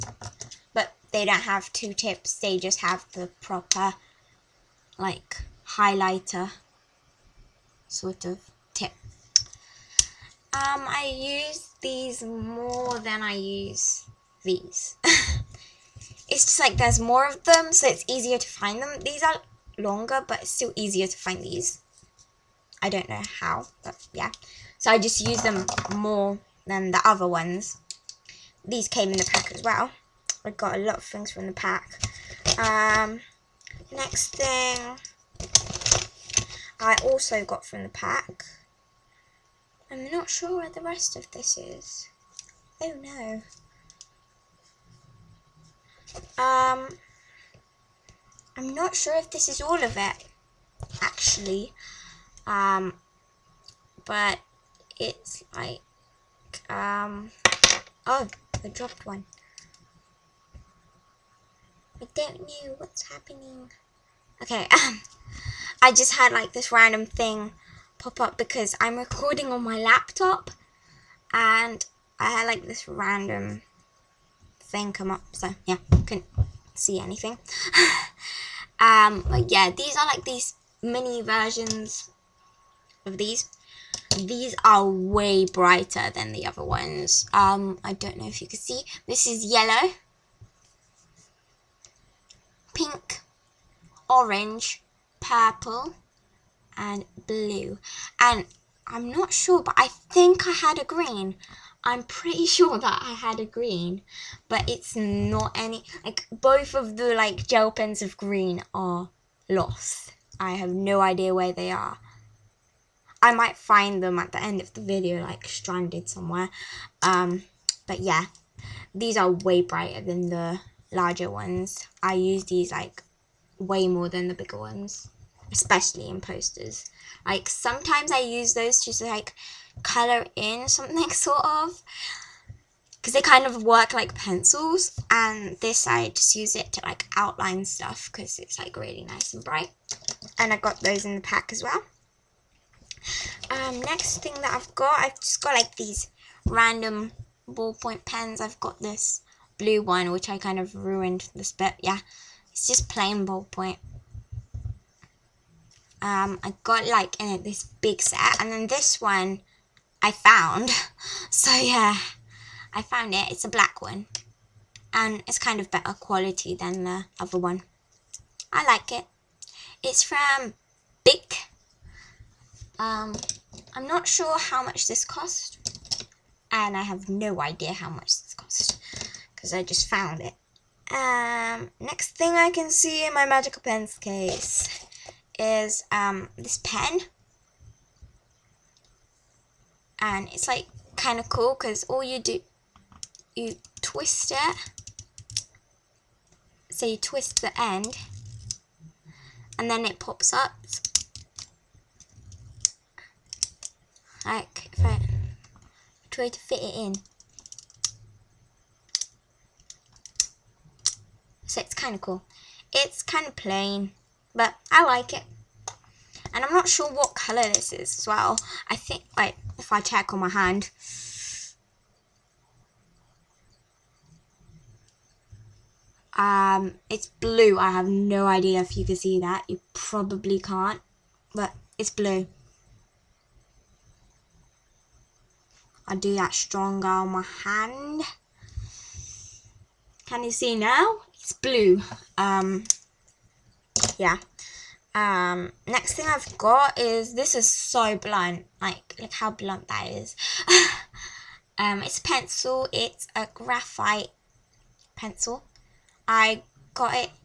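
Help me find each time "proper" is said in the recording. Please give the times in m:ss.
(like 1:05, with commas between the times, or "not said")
0:03.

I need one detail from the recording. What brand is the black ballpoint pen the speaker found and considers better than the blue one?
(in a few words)
Bic.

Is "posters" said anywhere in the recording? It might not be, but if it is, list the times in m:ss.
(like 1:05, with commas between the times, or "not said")
2:06.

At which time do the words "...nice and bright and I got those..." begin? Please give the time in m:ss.
2:19.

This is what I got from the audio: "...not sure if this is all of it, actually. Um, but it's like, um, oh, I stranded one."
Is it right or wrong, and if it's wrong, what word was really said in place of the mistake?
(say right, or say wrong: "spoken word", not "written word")
wrong: "dropped", not "stranded".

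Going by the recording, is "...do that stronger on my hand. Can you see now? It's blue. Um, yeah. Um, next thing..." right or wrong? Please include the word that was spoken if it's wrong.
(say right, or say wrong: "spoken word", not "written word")
right.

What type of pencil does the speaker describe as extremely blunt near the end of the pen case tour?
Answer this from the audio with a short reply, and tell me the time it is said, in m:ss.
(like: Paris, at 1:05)
graphite pencil, at 4:13.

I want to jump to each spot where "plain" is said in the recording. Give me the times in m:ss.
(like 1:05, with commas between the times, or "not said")
2:32, 3:33.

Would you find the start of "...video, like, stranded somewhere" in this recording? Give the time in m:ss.
1:54.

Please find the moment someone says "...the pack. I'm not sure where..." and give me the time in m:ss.
0:37.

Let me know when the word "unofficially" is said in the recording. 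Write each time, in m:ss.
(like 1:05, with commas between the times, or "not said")
not said.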